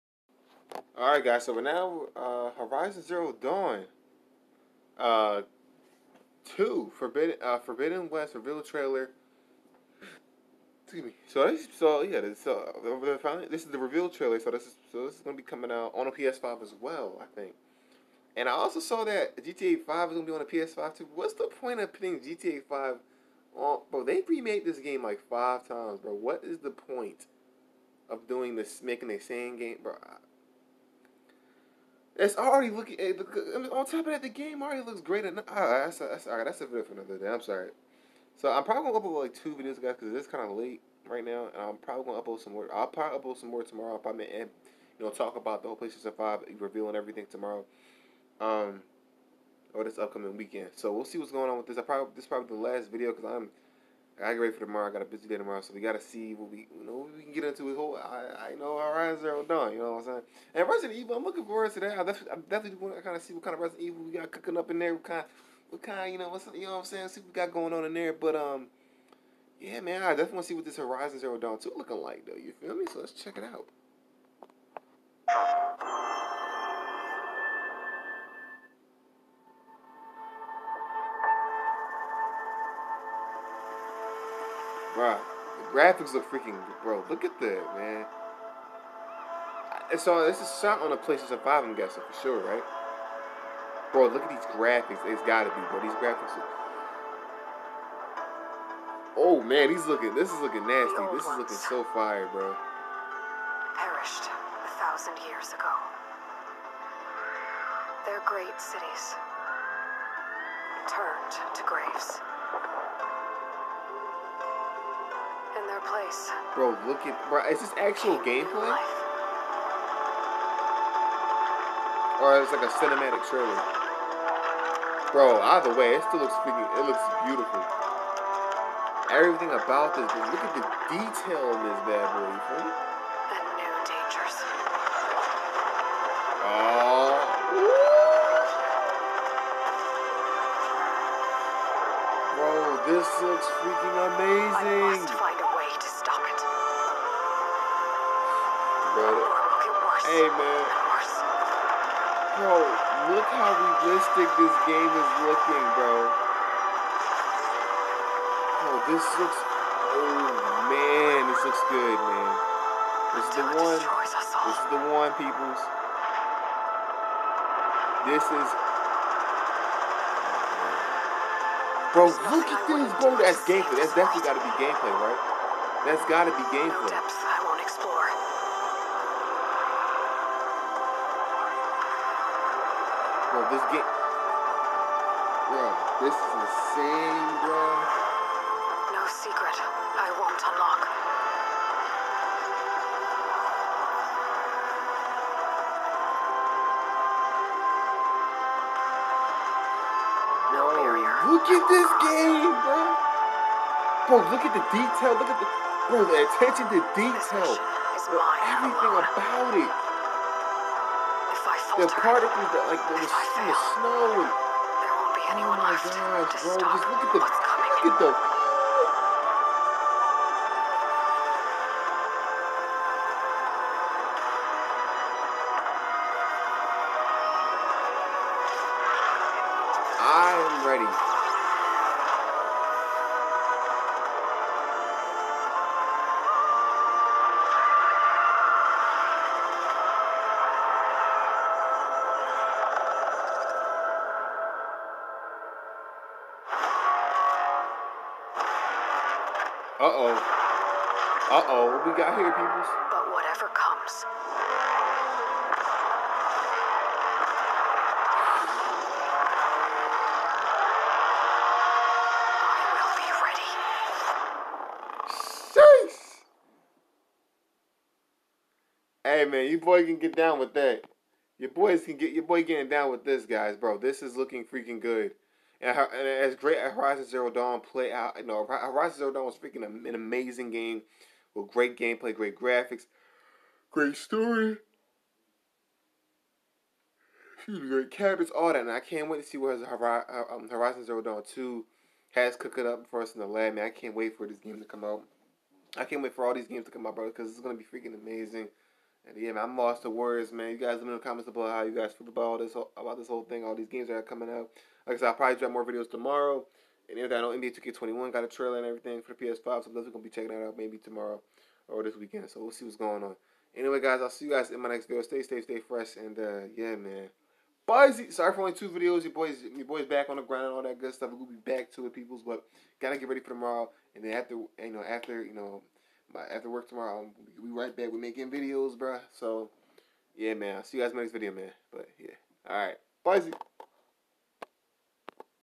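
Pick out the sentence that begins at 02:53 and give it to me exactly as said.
That's definitely got to be gameplay, right?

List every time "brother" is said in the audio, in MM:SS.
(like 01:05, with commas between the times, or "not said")
02:29, 04:56.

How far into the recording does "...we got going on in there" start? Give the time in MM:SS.
01:07.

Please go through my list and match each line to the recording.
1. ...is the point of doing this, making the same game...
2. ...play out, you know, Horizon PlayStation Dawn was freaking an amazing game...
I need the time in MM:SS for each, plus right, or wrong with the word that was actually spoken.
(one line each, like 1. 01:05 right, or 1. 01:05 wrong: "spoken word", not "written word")
1. 00:26 right
2. 04:37 wrong: "Zero", not "PlayStation".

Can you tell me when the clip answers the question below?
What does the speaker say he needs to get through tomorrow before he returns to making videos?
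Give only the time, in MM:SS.
05:26.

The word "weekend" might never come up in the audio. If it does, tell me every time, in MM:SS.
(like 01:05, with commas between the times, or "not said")
00:50, 05:11.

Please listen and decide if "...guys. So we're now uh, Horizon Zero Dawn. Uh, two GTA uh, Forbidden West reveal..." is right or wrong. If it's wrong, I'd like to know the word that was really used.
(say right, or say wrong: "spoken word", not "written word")
wrong: "Forbidden", not "GTA".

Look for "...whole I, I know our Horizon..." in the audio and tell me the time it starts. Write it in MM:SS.
00:57.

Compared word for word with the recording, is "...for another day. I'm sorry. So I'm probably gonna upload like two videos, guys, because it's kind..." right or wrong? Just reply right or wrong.
right.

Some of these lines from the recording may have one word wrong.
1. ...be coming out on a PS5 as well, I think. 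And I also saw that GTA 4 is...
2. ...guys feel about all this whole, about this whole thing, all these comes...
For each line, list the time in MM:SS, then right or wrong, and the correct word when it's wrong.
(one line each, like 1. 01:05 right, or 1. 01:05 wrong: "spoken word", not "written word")
1. 00:15 wrong: "5", not "4"
2. 05:01 wrong: "games", not "comes".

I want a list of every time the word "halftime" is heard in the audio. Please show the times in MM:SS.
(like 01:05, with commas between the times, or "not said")
not said.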